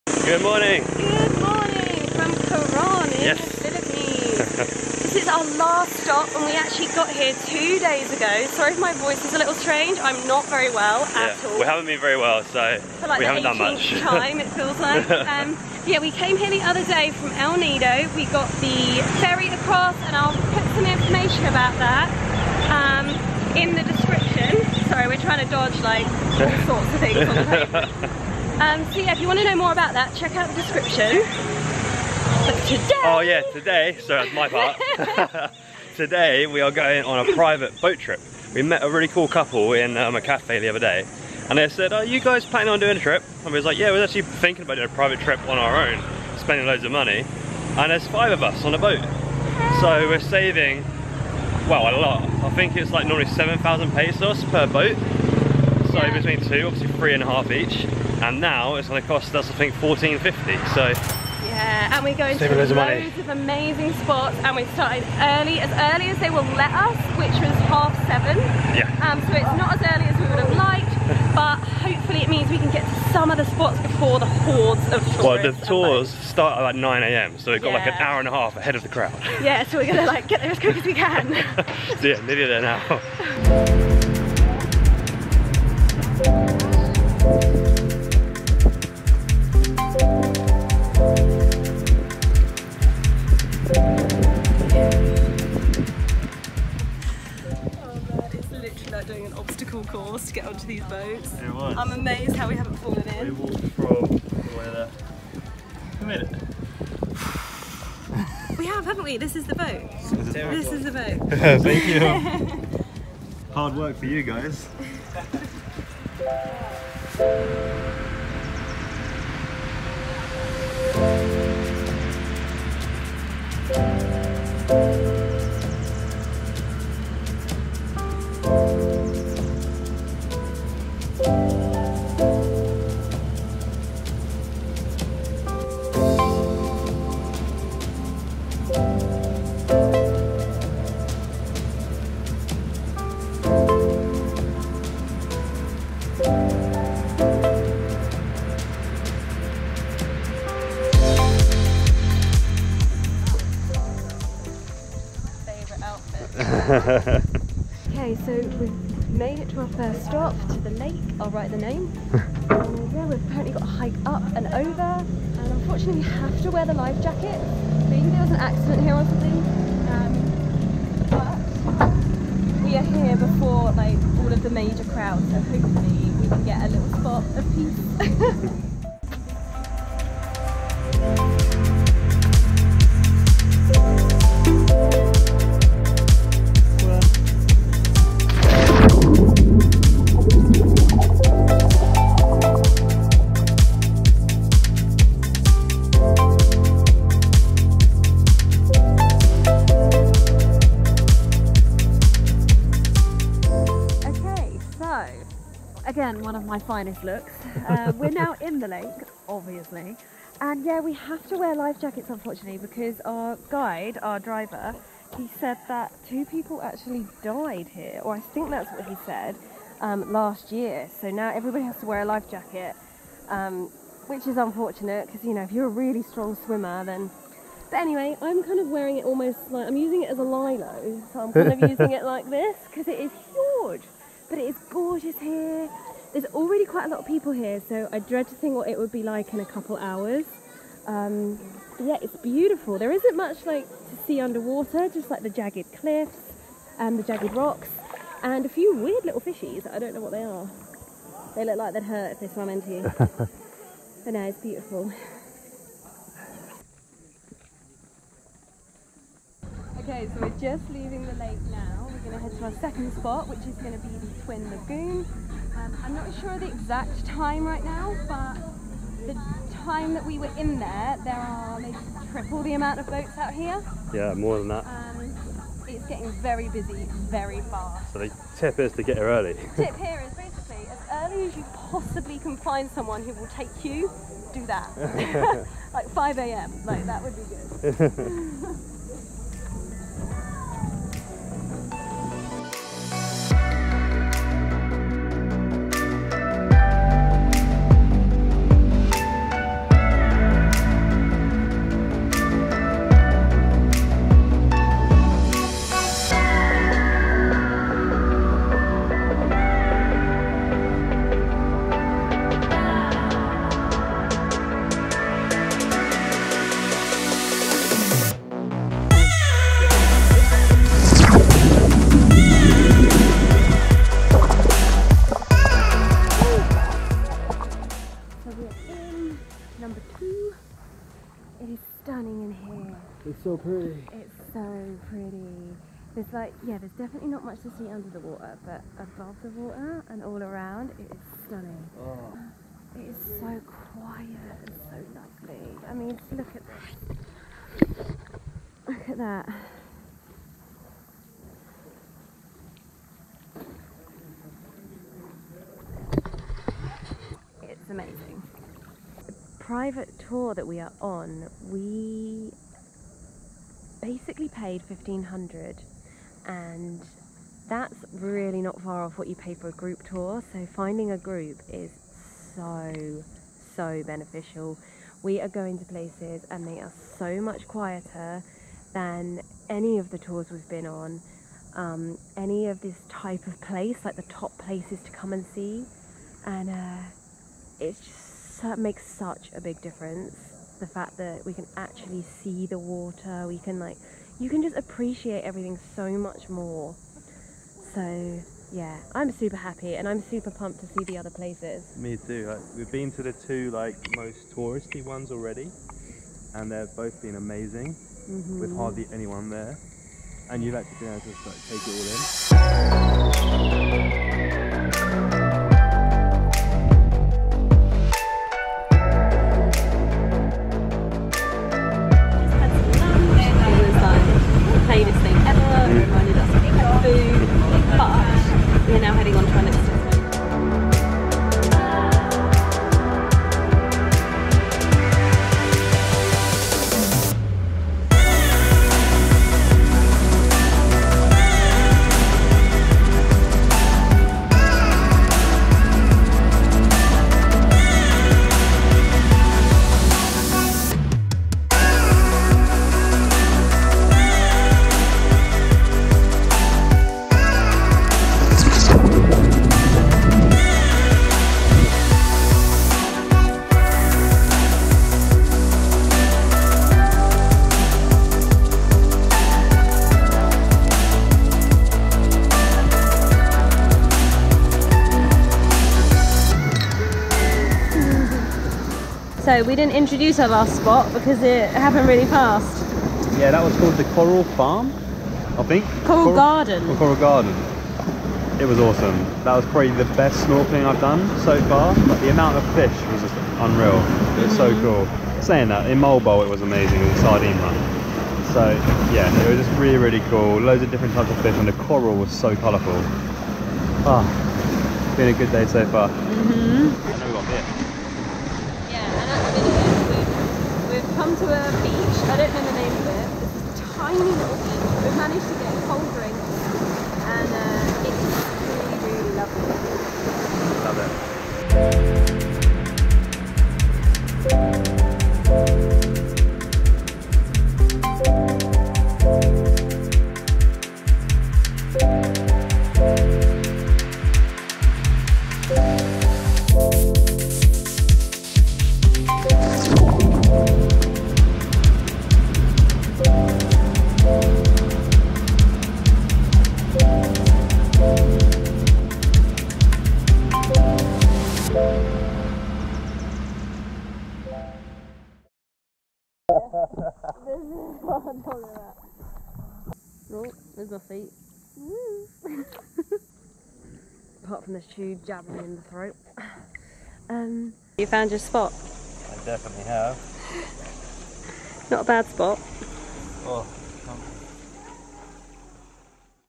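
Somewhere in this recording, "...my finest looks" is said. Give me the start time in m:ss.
3:26.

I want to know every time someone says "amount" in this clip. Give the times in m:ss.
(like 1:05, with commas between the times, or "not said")
4:32, 8:12.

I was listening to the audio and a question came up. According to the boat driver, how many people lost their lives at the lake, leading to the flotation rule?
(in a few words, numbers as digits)
2.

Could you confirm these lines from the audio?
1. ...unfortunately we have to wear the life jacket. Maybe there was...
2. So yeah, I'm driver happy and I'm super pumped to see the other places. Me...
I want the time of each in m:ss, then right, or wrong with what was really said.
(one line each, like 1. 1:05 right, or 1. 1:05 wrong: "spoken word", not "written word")
1. 2:45 right
2. 6:37 wrong: "super", not "driver".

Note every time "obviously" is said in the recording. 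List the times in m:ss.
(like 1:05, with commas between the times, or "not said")
0:56, 3:29.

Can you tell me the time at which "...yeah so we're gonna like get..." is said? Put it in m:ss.
1:19.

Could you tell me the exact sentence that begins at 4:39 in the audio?
tip here is basically as early as you possibly can find someone who will take you, do that.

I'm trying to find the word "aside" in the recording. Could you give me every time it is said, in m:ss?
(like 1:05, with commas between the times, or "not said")
not said.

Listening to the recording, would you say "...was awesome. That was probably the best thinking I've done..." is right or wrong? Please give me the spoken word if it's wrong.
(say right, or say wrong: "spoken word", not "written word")
wrong: "snorkeling", not "thinking".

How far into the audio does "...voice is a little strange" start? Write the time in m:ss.
0:08.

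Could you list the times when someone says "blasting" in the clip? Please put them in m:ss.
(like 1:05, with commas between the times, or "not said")
not said.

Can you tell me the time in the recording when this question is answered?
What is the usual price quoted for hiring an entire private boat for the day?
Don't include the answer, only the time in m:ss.
0:53.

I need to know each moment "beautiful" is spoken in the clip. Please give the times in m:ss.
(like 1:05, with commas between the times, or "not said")
4:02, 4:14.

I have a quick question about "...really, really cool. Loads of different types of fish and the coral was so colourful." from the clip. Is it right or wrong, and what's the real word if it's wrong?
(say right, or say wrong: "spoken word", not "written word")
right.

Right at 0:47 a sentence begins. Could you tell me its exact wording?
And there's five of us on a boat.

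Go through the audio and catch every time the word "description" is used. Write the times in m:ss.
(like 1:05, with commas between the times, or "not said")
0:23, 0:30.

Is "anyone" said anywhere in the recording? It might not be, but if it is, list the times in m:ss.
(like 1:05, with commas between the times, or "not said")
6:48.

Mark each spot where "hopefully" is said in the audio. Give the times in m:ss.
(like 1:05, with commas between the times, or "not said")
1:11, 2:55.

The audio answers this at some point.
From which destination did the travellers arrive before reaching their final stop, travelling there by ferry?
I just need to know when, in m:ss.
0:17.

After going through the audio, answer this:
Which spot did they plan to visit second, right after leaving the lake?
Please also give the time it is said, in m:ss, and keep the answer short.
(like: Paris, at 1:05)
Twin Lagoon, at 4:24.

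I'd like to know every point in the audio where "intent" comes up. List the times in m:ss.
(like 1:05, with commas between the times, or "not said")
not said.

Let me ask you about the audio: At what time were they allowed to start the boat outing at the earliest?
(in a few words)
7:30.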